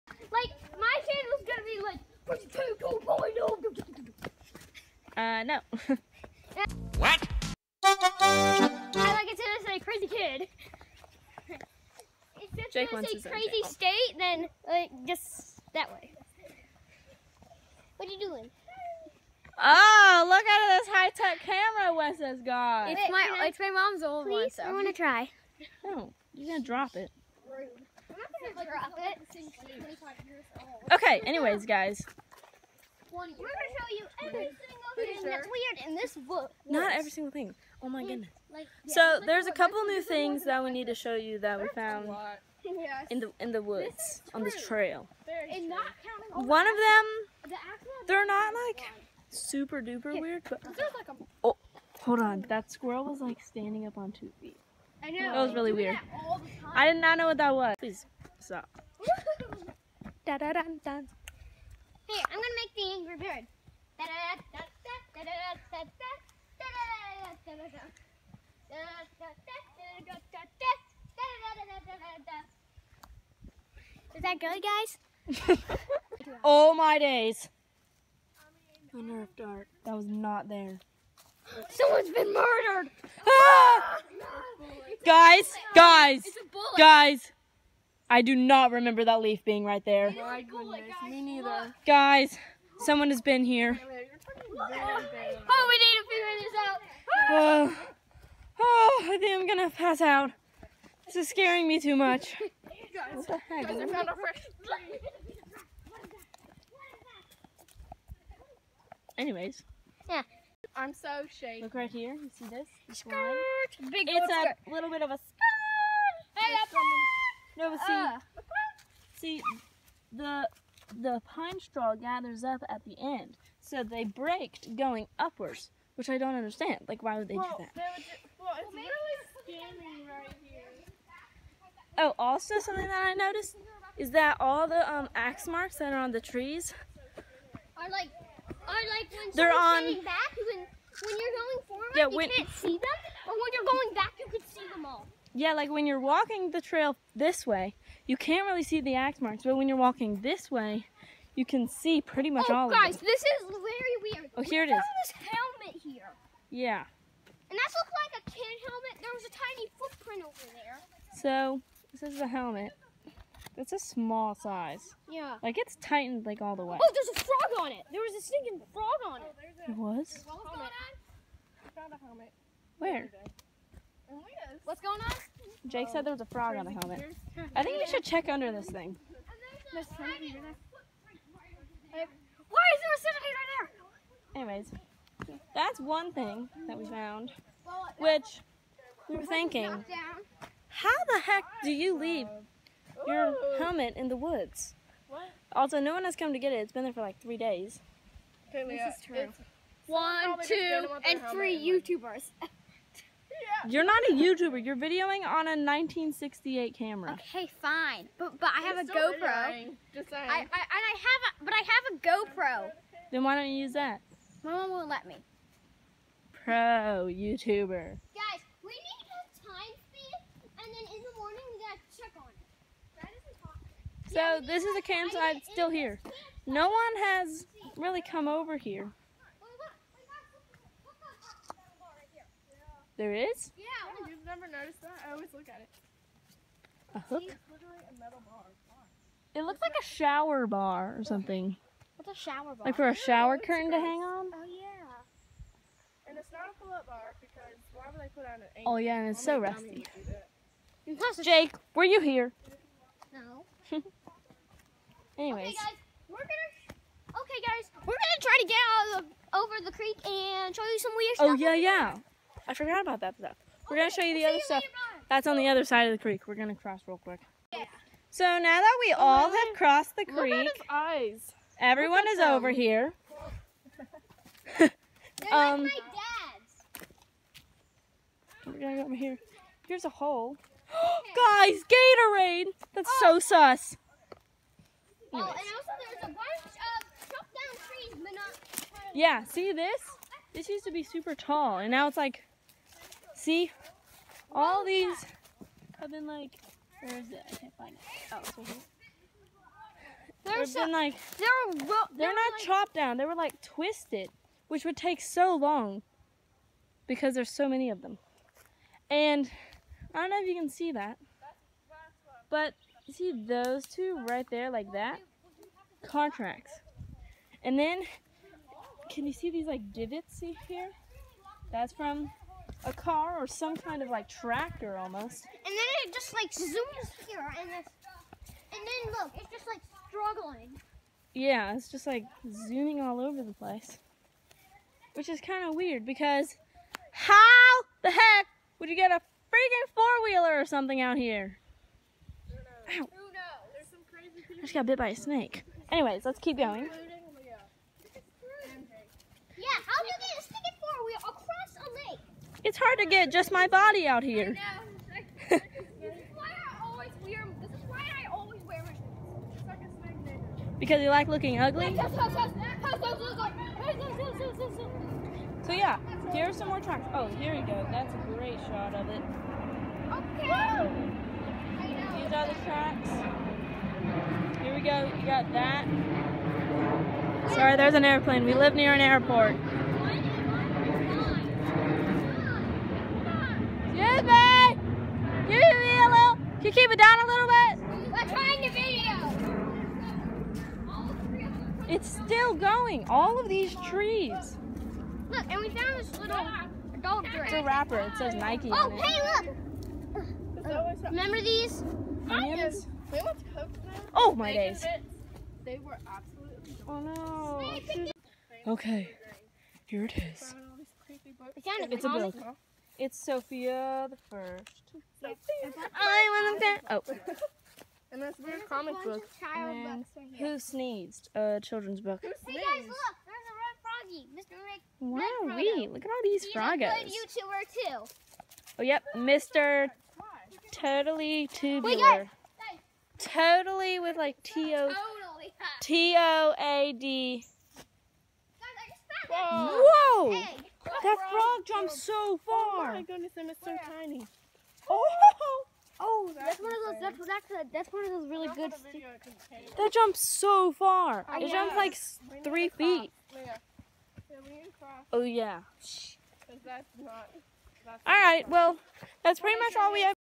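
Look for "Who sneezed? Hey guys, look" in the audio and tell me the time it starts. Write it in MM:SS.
07:02.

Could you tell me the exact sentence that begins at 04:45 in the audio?
Oh, and also there's a bunch of chopped down trees, but not...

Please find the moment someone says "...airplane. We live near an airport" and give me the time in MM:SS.
06:17.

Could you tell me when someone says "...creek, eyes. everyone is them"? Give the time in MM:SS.
04:30.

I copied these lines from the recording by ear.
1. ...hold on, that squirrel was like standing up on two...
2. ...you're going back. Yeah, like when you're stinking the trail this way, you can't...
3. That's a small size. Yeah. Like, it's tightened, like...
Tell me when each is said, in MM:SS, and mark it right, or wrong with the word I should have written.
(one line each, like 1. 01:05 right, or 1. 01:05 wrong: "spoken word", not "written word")
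1. 00:51 right
2. 02:23 wrong: "walking", not "stinking"
3. 02:43 right.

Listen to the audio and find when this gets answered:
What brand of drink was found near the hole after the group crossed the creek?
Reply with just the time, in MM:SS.
04:41.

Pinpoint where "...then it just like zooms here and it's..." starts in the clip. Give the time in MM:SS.
05:25.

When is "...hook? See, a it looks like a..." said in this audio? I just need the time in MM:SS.
03:56.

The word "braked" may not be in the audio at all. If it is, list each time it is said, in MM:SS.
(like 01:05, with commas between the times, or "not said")
02:04.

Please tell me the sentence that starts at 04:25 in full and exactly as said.
That's on the other side of the creek.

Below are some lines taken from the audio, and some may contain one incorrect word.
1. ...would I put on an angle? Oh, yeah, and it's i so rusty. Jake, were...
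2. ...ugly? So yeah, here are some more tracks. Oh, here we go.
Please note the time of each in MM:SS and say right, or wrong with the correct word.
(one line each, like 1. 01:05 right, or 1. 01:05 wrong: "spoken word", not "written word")
1. 04:07 right
2. 06:01 right.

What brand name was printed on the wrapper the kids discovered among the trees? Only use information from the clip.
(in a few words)
Nike.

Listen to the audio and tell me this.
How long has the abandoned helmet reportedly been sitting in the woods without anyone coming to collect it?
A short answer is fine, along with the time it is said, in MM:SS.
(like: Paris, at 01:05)
three days, at 03:17.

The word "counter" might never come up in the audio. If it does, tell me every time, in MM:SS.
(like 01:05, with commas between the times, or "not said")
not said.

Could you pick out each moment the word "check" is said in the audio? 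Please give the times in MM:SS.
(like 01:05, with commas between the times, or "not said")
02:58, 03:41.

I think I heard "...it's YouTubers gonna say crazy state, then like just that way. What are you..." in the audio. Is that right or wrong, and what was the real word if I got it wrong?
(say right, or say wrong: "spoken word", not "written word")
wrong: "Jake", not "YouTubers".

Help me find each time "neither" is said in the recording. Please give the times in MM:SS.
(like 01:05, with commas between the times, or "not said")
01:31.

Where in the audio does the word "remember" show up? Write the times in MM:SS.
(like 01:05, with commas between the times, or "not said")
01:28, 06:40.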